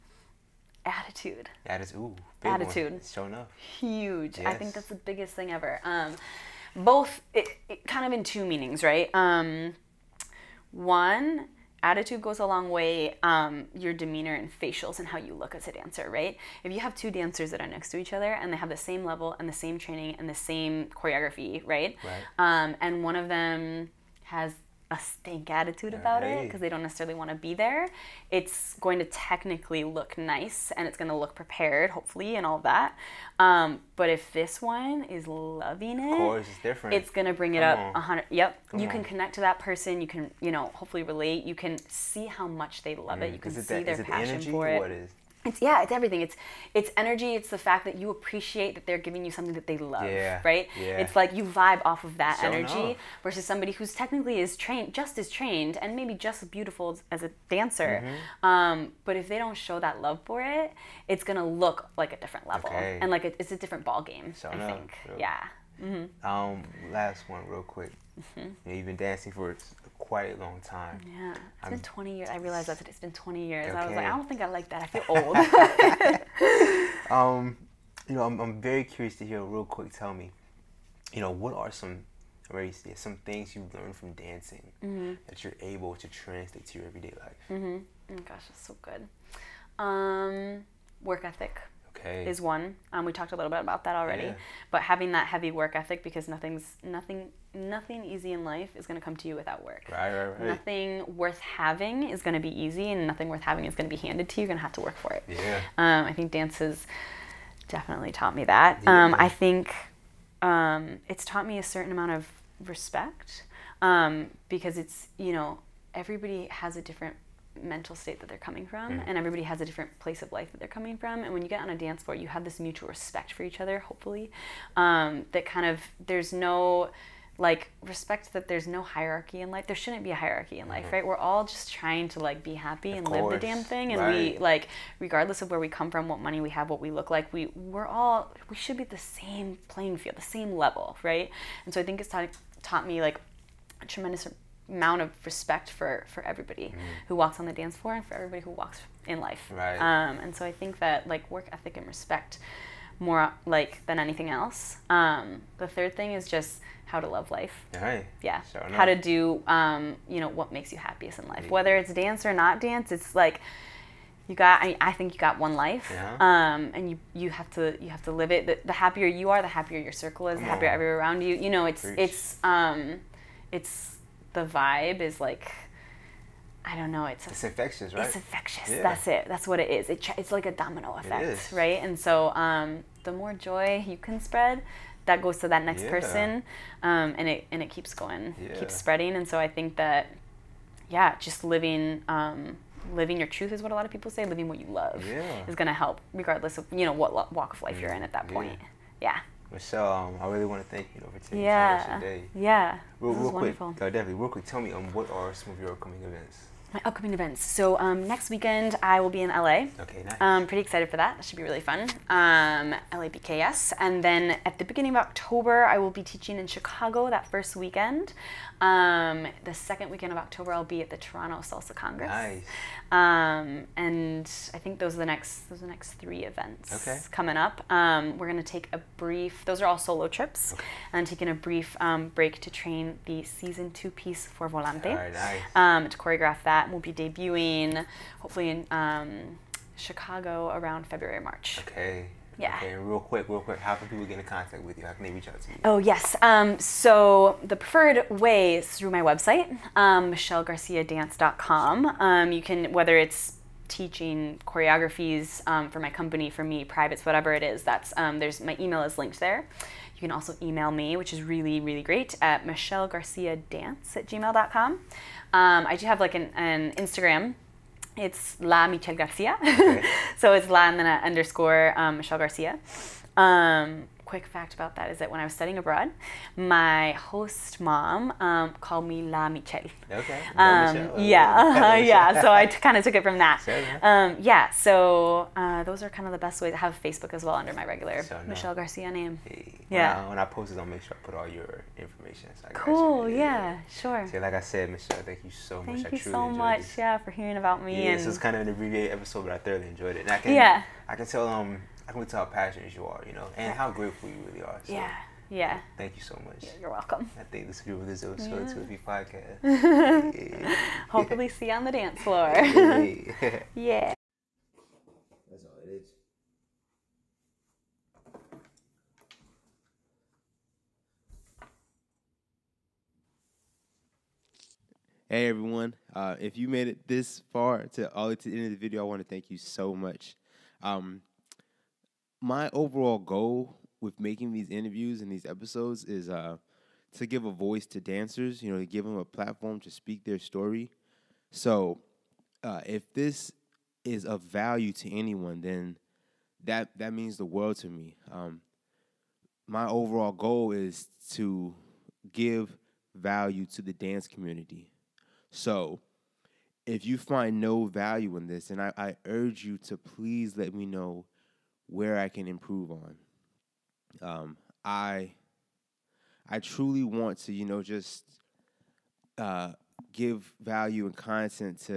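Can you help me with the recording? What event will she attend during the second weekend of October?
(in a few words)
Toronto Salsa Congress.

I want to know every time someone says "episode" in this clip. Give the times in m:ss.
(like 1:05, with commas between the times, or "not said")
4:58, 5:08, 5:35.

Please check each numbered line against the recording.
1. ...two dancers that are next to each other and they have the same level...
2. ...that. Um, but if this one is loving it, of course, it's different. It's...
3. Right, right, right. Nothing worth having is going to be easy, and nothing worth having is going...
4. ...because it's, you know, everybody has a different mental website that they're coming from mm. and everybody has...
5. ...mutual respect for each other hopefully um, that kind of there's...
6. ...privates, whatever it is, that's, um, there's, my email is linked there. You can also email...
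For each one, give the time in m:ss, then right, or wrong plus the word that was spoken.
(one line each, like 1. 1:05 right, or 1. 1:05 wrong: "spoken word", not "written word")
1. 0:16 right
2. 0:32 right
3. 1:39 right
4. 1:54 wrong: "state", not "website"
5. 2:02 right
6. 4:16 right.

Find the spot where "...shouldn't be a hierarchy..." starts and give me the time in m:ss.
2:09.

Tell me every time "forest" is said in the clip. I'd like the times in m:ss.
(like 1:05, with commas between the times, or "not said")
not said.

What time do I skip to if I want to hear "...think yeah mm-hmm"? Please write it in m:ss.
1:04.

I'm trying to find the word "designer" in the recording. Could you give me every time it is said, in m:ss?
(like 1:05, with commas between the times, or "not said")
not said.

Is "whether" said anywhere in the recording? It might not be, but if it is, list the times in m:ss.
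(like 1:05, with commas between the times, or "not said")
2:41, 4:12.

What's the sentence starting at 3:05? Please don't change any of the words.
person, um, and it and it keeps going, yeah.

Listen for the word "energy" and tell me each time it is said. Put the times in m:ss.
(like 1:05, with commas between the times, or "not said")
0:46, 0:52.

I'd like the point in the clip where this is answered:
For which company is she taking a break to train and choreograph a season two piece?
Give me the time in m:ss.
3:54.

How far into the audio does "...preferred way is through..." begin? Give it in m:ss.
4:07.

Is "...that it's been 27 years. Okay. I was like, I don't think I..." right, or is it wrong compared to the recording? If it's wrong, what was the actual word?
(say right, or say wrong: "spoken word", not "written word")
wrong: "20", not "27".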